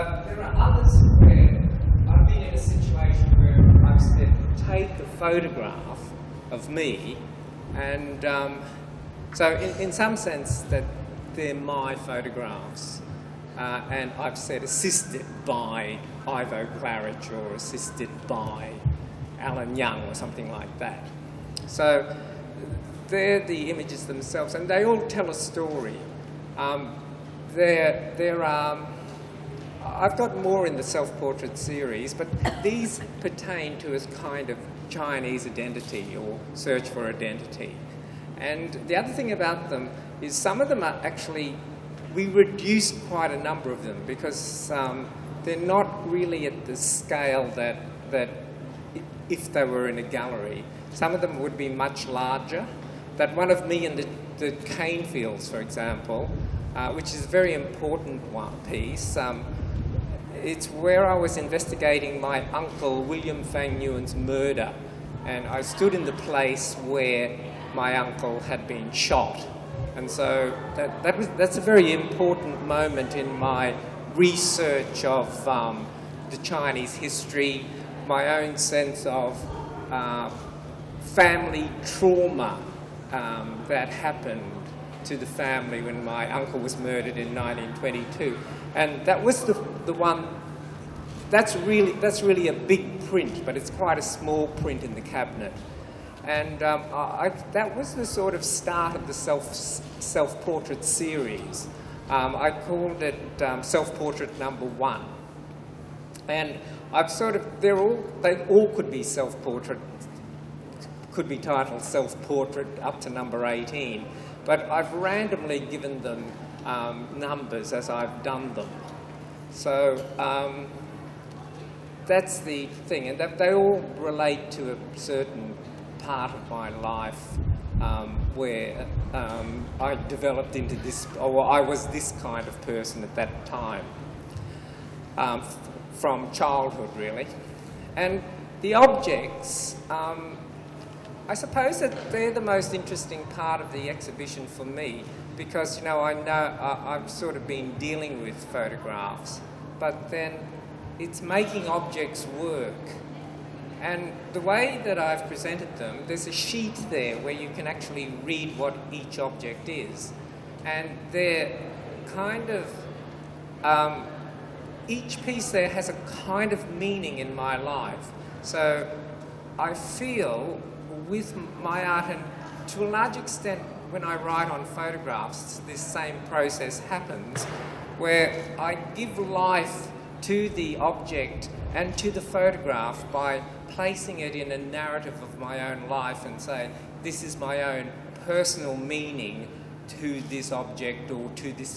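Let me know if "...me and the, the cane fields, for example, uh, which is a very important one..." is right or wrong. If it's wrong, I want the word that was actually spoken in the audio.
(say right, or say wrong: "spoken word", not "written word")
right.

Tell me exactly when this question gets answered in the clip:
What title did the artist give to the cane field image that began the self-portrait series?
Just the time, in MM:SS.
01:43.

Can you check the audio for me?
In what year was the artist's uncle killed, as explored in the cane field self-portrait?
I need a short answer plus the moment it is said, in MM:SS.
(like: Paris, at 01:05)
1922, at 01:27.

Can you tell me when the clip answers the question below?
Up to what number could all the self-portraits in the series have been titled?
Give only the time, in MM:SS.
01:53.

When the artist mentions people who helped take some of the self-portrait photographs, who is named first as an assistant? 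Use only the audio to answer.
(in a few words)
Ivo Claridge.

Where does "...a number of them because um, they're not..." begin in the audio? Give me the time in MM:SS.
00:43.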